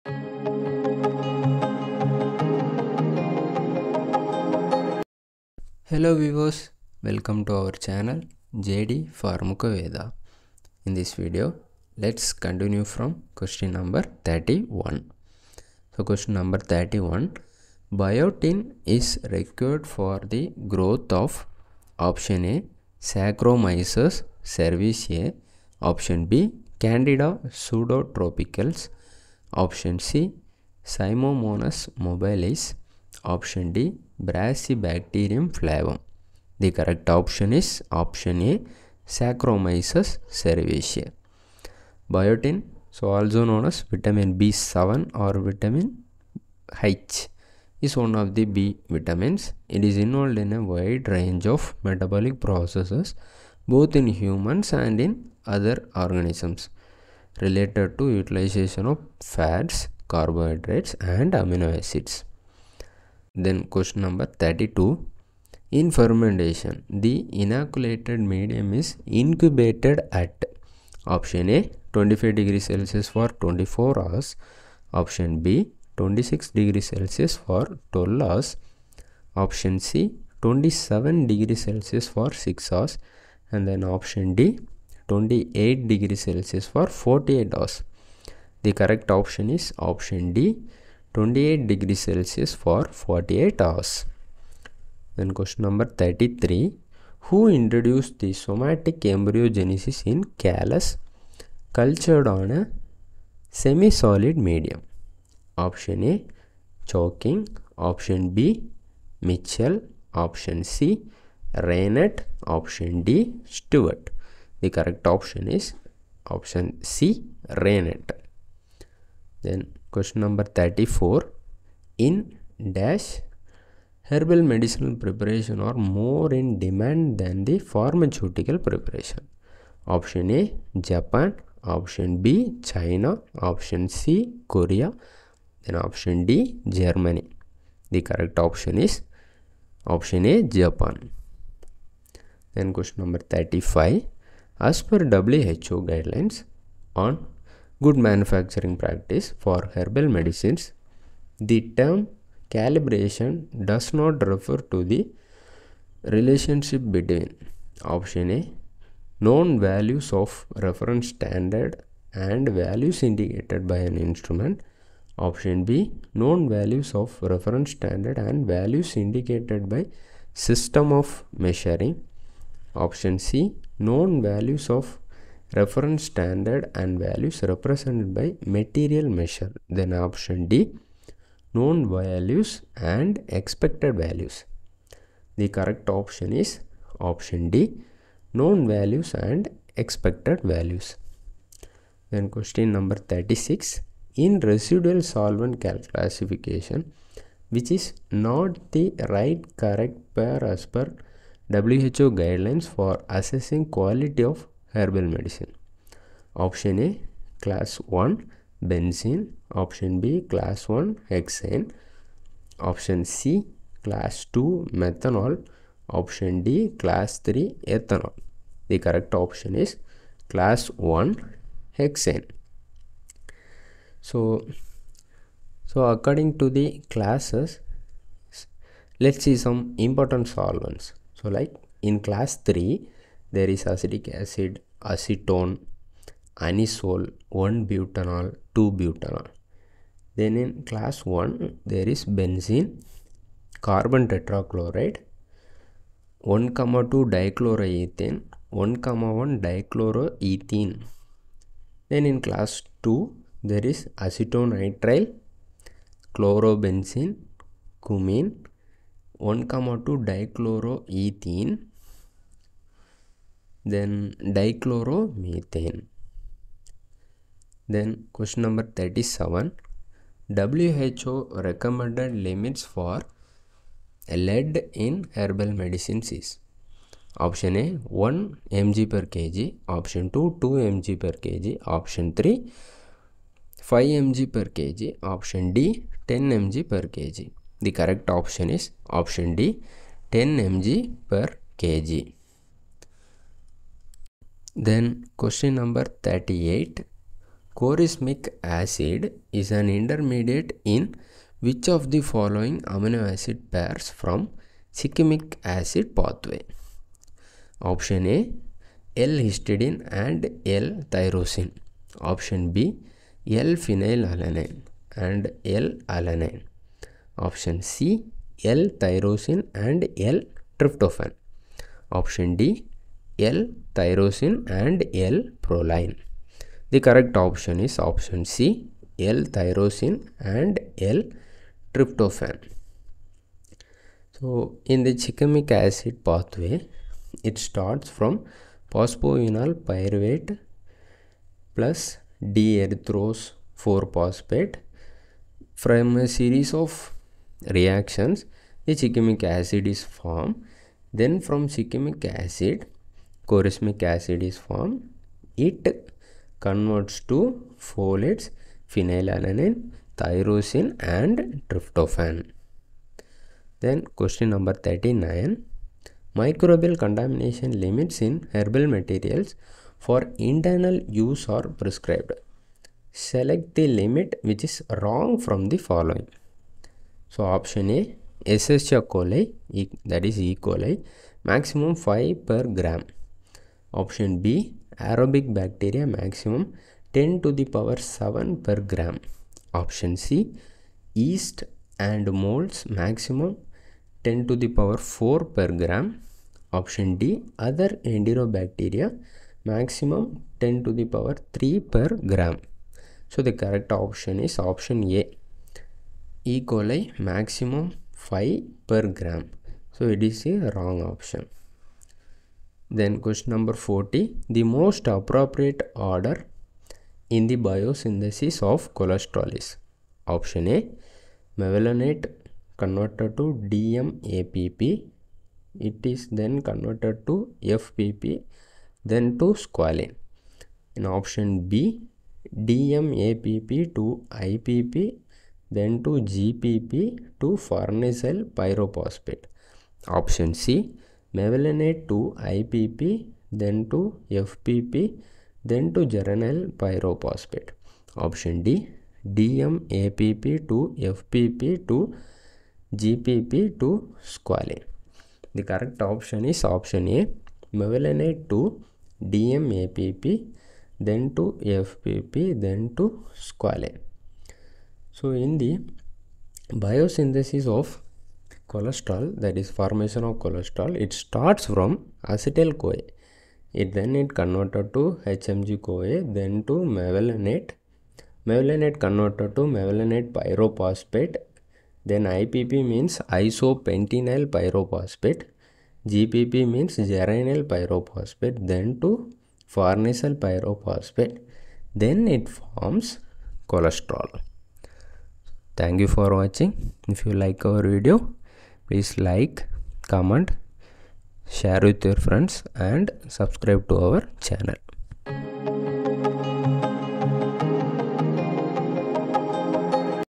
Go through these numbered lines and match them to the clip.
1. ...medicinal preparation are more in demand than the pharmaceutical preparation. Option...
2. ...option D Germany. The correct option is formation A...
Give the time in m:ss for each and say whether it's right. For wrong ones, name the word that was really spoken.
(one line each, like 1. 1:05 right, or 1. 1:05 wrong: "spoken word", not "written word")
1. 2:04 right
2. 2:15 wrong: "option", not "formation".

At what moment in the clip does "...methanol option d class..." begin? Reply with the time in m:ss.
3:34.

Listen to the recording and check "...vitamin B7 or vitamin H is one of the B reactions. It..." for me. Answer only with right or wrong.
wrong.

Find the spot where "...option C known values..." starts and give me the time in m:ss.
2:52.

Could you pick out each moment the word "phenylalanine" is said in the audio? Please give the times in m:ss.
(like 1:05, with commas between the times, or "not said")
5:13, 5:58.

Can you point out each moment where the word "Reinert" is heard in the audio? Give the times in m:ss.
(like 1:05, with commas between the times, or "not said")
1:51, 1:57.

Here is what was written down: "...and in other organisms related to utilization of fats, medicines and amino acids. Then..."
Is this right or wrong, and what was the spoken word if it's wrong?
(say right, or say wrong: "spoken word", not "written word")
wrong: "carbohydrates", not "medicines".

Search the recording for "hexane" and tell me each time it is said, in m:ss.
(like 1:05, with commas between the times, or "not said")
3:31, 3:41.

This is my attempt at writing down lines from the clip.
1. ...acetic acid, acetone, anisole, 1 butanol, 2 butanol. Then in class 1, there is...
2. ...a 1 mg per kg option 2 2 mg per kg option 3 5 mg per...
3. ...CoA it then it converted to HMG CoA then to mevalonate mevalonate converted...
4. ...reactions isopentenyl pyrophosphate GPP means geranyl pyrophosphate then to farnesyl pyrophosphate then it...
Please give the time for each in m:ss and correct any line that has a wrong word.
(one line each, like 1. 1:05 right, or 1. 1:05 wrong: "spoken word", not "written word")
1. 3:53 right
2. 4:37 right
3. 7:52 right
4. 8:02 wrong: "means", not "reactions".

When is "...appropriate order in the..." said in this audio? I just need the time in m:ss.
6:54.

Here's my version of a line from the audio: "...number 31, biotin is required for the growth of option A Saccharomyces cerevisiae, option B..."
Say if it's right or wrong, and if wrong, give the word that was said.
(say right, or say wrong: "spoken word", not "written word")
right.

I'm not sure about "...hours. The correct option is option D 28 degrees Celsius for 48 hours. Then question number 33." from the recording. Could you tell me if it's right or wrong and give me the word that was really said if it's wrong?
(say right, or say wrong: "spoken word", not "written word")
right.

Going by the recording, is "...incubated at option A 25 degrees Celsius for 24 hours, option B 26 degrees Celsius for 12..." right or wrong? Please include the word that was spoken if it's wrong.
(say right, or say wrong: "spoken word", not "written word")
right.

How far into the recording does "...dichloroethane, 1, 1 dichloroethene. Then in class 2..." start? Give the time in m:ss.
4:07.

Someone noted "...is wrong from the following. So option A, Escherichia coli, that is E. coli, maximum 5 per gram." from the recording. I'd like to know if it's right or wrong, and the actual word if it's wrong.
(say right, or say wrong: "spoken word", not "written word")
right.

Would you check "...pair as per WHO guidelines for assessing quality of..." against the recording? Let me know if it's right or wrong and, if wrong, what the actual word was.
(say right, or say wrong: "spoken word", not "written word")
right.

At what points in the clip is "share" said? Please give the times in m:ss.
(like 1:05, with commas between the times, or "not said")
8:21.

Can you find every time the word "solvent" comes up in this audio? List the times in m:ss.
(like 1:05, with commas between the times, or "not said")
3:15, 3:50.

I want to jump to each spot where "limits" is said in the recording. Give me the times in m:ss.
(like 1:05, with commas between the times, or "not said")
4:32, 6:07, 6:13.